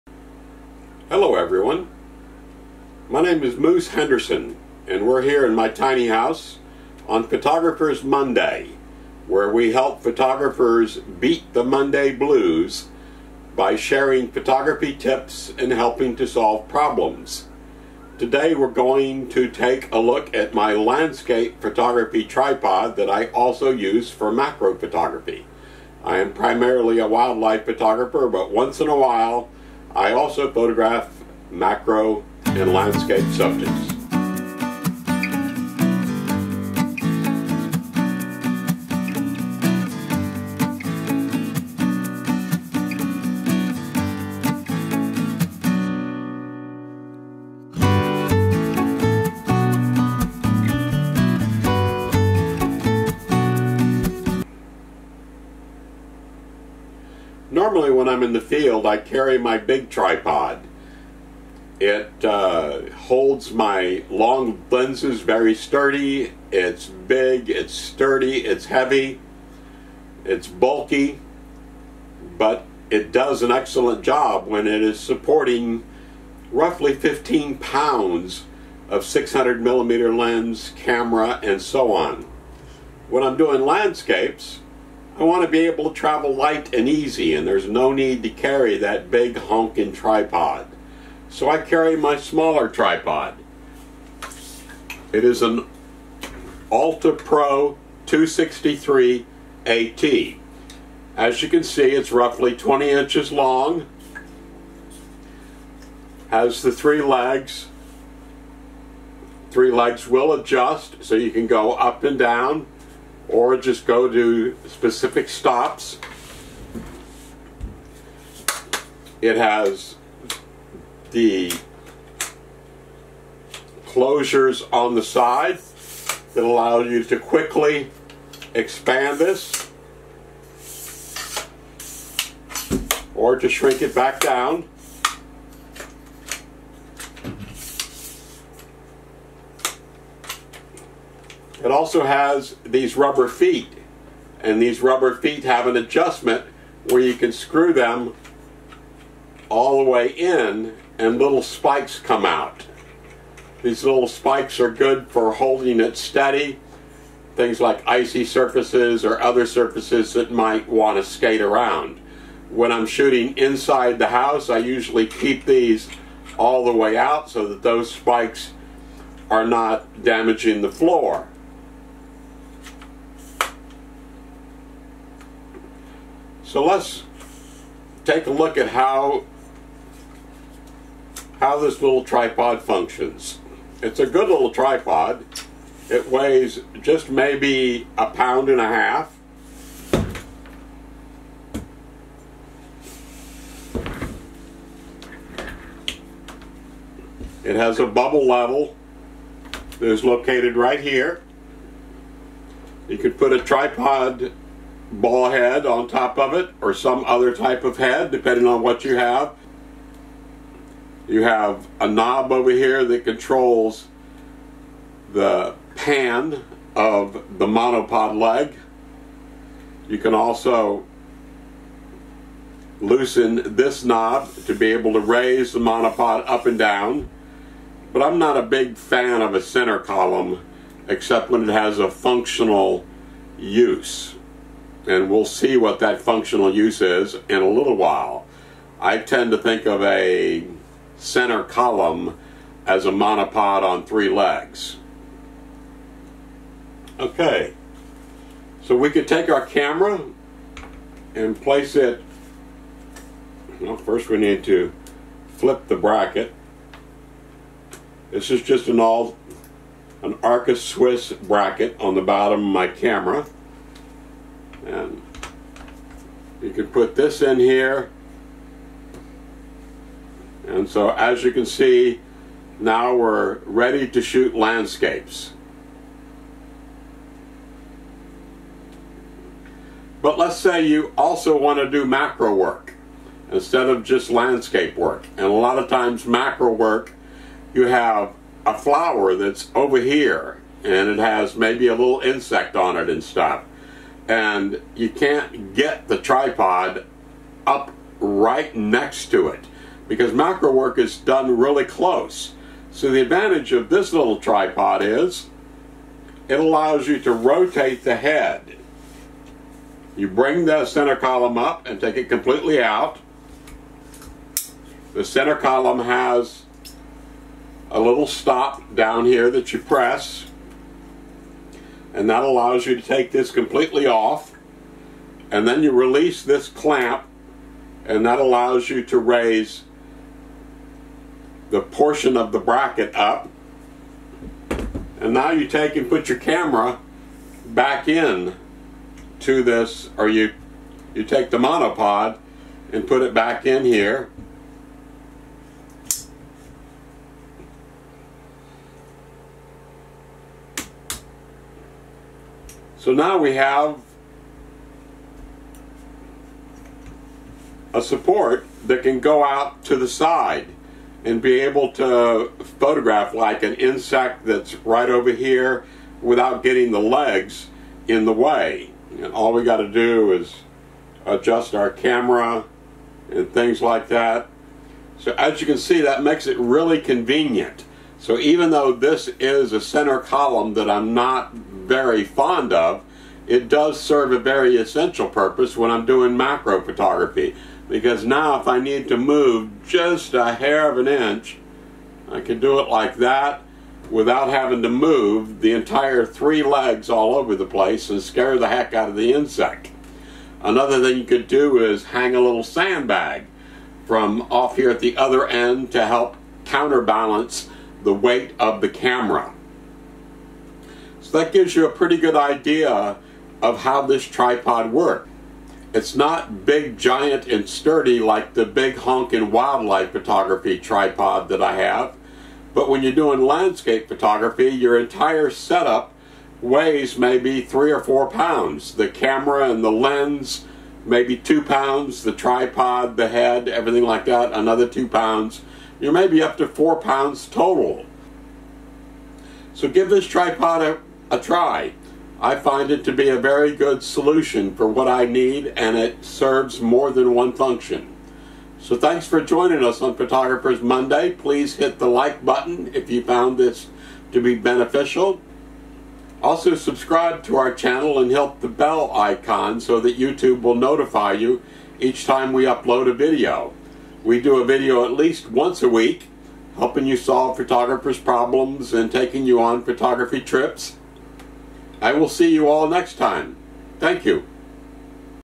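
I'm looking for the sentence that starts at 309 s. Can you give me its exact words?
You bring the center column up and take it completely out.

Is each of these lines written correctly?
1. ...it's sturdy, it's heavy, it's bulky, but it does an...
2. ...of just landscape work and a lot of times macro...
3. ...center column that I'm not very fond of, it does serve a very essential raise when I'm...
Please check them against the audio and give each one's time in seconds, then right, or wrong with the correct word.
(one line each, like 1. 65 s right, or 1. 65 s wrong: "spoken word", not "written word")
1. 67 s right
2. 283 s right
3. 379 s wrong: "purpose", not "raise".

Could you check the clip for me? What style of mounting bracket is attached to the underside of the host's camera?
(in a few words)
Arca Swiss.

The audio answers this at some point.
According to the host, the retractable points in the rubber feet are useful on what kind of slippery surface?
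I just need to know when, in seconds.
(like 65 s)
157 s.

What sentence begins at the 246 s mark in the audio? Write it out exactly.
Okay, so we could take our camera and place it, well first we need to flip the bracket.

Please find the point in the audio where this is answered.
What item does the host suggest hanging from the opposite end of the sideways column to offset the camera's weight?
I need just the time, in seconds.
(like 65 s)
402 s.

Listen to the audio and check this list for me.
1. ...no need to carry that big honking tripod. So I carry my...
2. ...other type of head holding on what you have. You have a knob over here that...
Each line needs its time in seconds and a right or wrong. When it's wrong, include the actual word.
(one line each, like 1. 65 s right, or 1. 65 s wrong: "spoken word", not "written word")
1. 87 s right
2. 207 s wrong: "depending", not "holding".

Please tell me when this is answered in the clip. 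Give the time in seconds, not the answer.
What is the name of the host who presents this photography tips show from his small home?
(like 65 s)
3 s.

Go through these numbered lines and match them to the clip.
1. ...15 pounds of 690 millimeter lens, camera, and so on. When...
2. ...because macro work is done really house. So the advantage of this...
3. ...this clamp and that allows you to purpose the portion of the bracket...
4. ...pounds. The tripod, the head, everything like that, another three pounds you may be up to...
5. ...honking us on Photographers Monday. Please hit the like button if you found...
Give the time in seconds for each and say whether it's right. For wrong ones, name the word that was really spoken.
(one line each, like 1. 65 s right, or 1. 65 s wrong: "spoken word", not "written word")
1. 76 s wrong: "600", not "690"
2. 299 s wrong: "close", not "house"
3. 326 s wrong: "raise", not "purpose"
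4. 431 s wrong: "two", not "three"
5. 449 s wrong: "joining", not "honking".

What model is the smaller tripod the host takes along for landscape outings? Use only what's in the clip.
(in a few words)
Alta Pro 263 AT.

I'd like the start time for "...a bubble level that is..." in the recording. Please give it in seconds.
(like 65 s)
197 s.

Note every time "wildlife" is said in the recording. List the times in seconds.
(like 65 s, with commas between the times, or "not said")
27 s, 419 s.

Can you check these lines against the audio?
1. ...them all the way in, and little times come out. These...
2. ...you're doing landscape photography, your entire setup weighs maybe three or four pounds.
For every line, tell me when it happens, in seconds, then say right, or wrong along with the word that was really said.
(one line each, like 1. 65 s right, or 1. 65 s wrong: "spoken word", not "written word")
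1. 147 s wrong: "spikes", not "times"
2. 422 s right.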